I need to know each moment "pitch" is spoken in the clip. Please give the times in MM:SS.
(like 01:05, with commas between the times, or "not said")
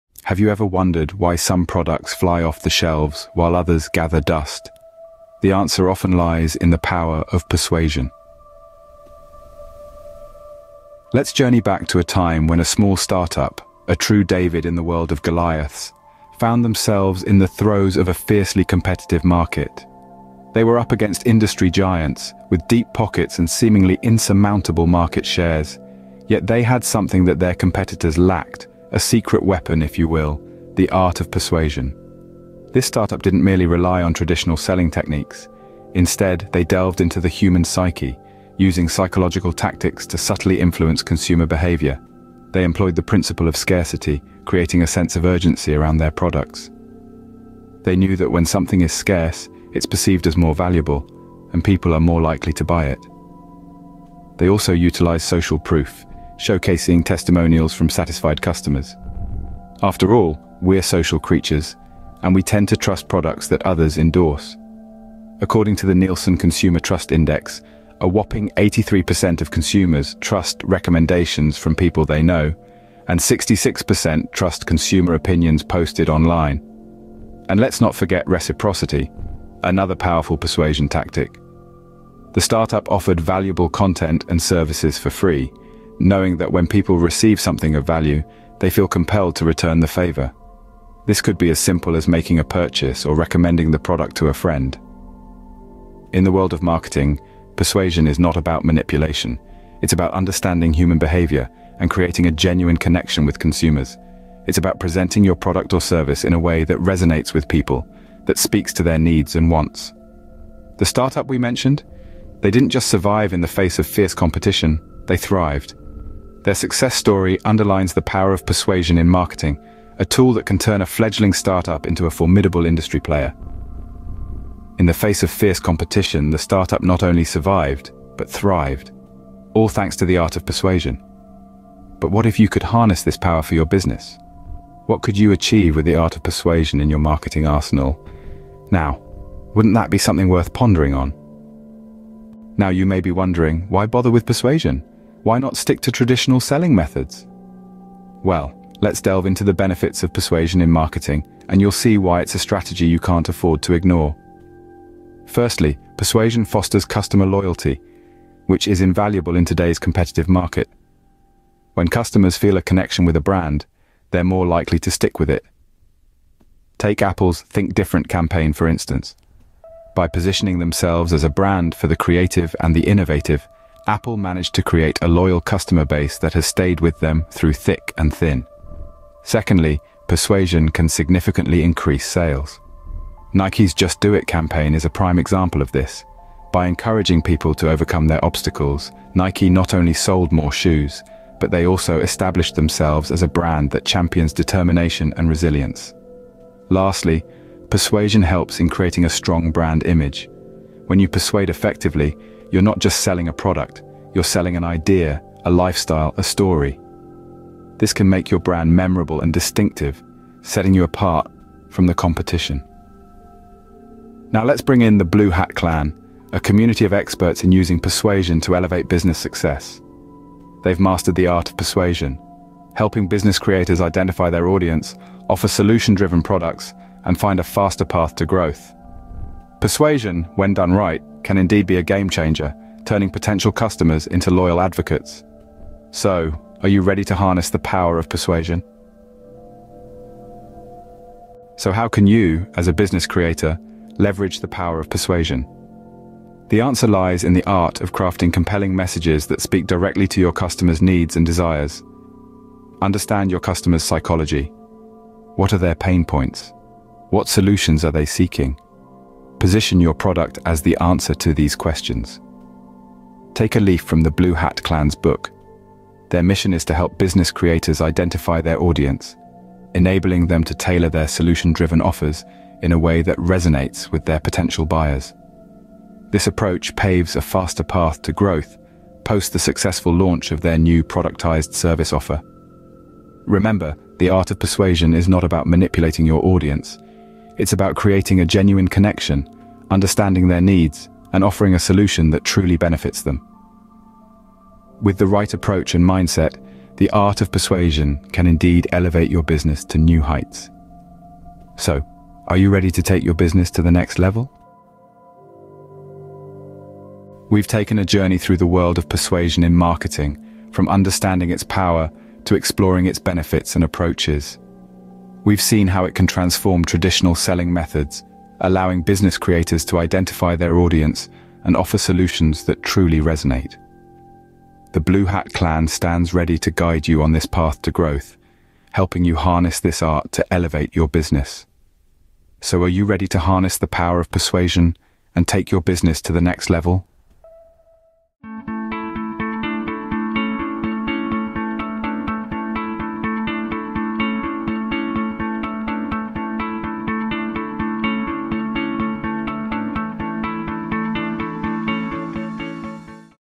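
not said.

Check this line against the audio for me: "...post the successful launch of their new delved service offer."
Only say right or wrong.
wrong.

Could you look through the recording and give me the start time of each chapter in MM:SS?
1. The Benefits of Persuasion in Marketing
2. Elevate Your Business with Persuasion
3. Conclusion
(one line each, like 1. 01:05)
1. 02:22
2. 04:01
3. 05:07.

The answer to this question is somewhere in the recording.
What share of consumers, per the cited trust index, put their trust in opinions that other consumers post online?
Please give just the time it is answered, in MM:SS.
01:13.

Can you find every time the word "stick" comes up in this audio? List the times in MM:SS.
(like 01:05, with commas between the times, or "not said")
02:25, 02:44.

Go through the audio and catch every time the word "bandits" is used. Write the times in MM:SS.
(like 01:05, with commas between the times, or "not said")
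not said.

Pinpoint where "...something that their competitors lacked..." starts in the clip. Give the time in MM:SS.
00:26.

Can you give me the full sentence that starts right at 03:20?
When you persuade effectively, you're not just selling a product, you're selling an idea, a lifestyle, a story.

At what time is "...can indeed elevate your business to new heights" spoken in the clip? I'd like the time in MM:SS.
04:58.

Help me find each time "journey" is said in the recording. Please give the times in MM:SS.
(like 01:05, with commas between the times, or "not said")
00:11, 05:07.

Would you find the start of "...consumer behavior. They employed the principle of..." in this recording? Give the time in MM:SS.
00:41.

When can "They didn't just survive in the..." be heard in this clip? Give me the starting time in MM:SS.
01:52.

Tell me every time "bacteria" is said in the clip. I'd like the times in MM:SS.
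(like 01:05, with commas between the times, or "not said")
not said.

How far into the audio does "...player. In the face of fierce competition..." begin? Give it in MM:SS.
02:02.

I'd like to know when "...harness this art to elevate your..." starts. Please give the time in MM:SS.
05:29.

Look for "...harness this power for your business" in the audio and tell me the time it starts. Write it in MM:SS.
02:12.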